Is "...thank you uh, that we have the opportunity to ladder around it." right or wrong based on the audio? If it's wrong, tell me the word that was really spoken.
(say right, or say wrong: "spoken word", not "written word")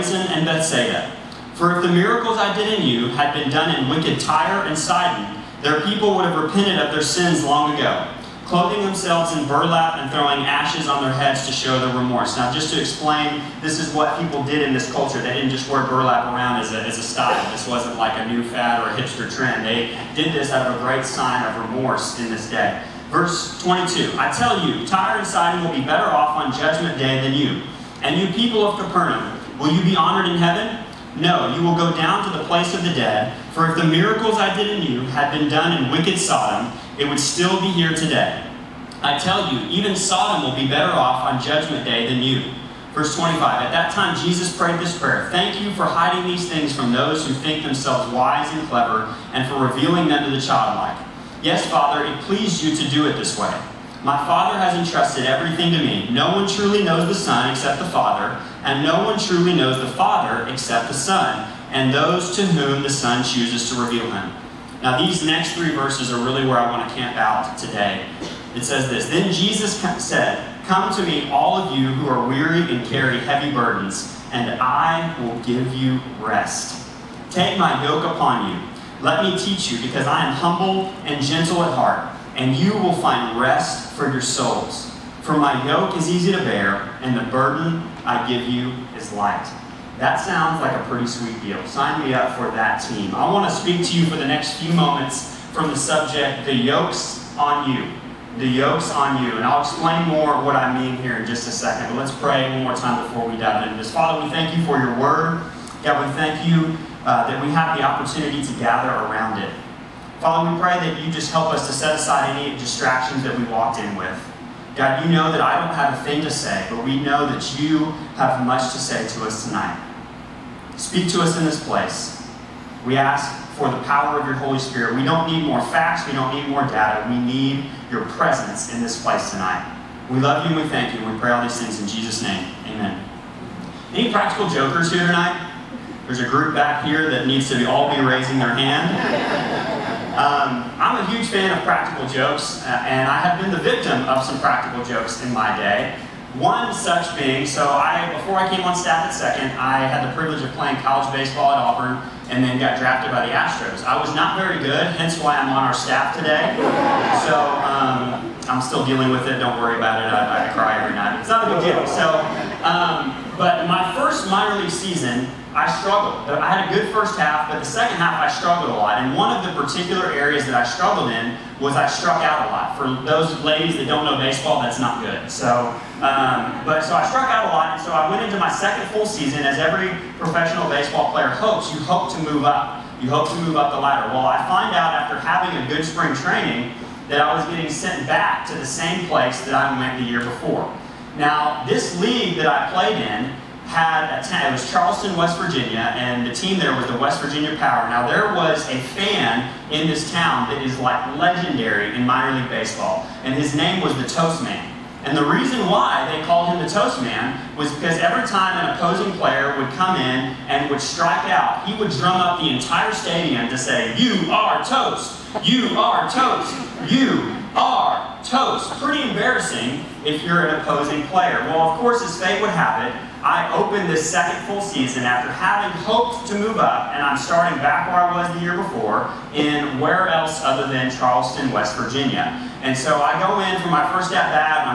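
wrong: "gather", not "ladder".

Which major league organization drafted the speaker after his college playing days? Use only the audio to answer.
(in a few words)
Astros.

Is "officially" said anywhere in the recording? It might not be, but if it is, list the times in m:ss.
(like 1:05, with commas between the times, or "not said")
not said.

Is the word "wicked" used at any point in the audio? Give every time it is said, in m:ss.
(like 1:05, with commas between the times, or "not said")
0:03, 0:35.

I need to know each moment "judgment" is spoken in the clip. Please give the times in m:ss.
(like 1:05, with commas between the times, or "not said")
0:26, 0:41.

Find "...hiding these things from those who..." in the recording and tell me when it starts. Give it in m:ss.
0:45.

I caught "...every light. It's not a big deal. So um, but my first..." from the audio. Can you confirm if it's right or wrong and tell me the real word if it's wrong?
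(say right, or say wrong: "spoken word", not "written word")
wrong: "night", not "light".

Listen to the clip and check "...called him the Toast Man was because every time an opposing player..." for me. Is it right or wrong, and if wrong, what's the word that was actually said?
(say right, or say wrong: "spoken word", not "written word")
right.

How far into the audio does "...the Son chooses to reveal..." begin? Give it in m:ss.
1:02.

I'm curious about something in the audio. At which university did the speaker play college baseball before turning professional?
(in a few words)
Auburn.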